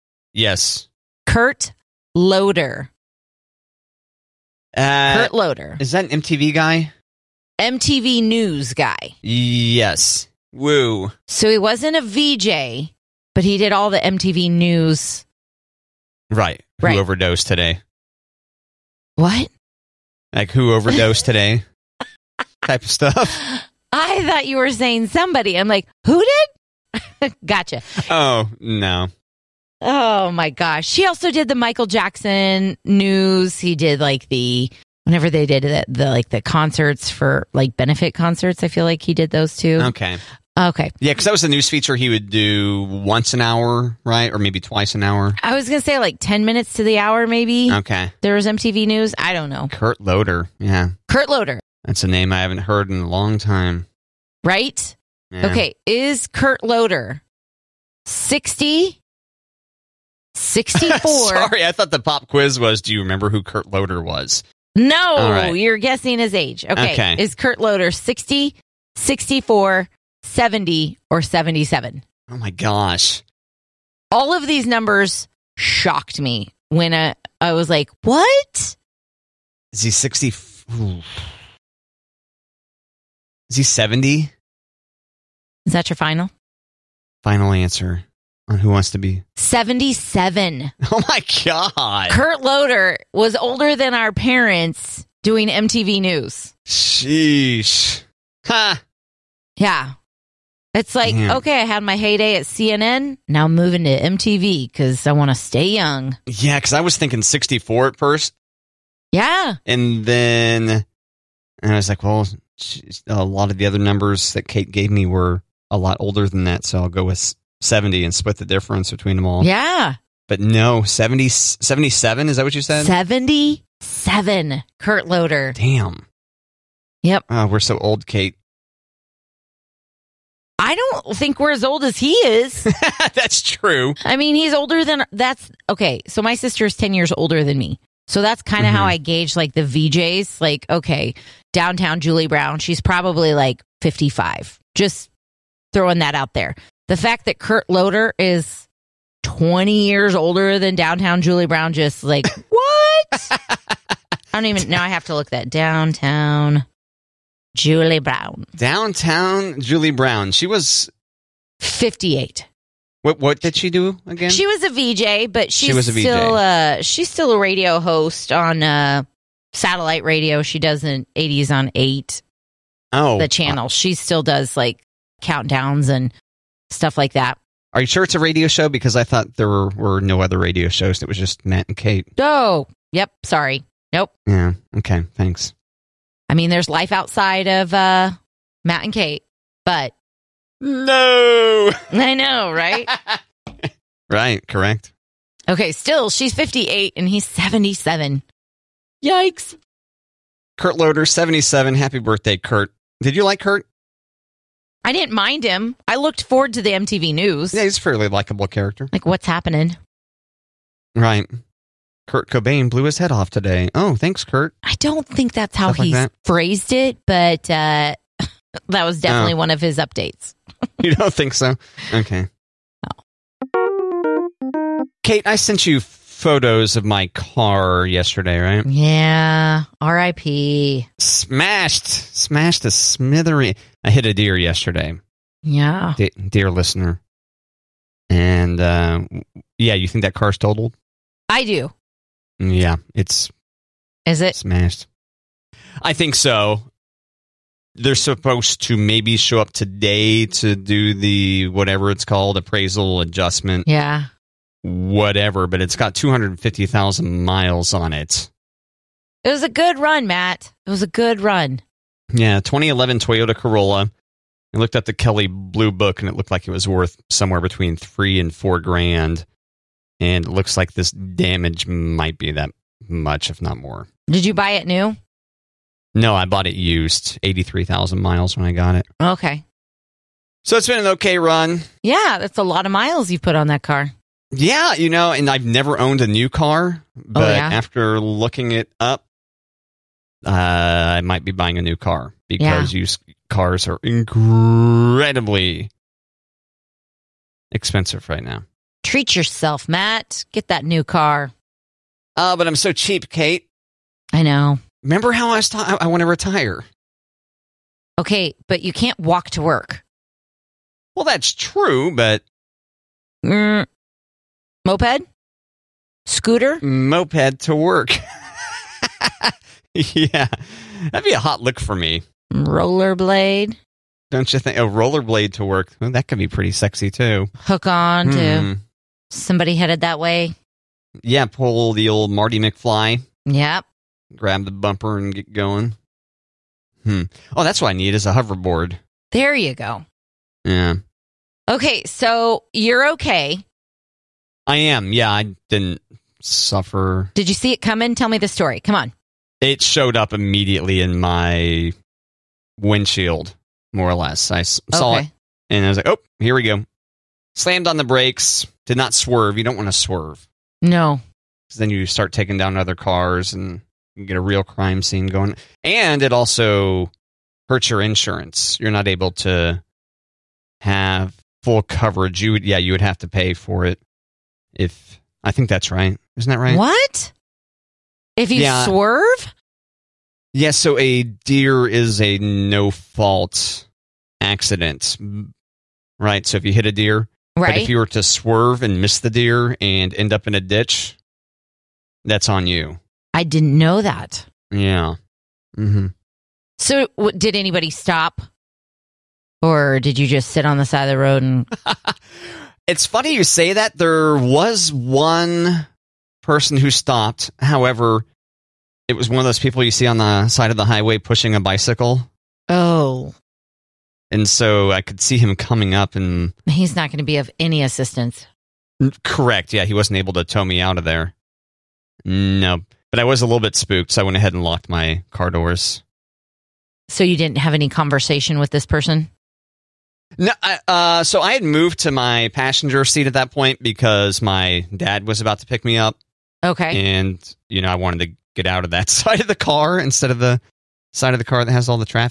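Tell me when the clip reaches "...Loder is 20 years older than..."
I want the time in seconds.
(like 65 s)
147 s.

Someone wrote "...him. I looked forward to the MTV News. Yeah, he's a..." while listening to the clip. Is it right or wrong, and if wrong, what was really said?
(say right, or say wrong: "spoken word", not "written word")
right.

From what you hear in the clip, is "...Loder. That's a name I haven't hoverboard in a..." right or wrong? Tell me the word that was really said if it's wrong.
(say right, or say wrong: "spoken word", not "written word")
wrong: "heard", not "hoverboard".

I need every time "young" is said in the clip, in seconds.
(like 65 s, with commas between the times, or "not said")
105 s.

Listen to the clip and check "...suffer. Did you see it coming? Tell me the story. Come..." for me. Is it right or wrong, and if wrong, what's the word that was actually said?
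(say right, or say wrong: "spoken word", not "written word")
right.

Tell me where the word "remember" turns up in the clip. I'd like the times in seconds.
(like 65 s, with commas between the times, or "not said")
63 s, 304 s.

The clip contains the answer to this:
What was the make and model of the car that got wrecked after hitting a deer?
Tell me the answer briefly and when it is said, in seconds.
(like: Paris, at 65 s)
Toyota Corolla, at 262 s.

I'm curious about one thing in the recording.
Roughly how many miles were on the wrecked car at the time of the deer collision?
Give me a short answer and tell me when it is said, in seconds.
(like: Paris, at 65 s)
250,000, at 255 s.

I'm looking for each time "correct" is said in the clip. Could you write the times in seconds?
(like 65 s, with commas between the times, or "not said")
194 s, 419 s.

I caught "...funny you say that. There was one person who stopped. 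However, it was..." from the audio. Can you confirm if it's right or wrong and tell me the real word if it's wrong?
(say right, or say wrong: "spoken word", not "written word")
right.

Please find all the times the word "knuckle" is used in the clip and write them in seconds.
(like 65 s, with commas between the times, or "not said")
not said.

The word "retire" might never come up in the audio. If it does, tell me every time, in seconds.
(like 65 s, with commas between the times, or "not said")
306 s.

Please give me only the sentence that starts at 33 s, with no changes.
He did like the whenever they did the, the like the concerts for like benefit concerts.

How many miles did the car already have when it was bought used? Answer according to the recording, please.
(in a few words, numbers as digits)
83,000.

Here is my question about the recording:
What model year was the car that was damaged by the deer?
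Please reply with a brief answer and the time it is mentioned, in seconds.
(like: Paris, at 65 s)
2011, at 262 s.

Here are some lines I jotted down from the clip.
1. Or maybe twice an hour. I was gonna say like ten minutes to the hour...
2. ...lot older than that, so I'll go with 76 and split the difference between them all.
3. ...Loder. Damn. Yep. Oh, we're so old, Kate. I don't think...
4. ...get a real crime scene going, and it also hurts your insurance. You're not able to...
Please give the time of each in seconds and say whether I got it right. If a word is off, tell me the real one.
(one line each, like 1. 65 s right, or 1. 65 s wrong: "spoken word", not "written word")
1. 44 s right
2. 115 s wrong: "70", not "76"
3. 125 s right
4. 364 s right.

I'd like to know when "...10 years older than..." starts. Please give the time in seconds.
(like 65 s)
136 s.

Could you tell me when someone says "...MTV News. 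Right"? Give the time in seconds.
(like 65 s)
13 s.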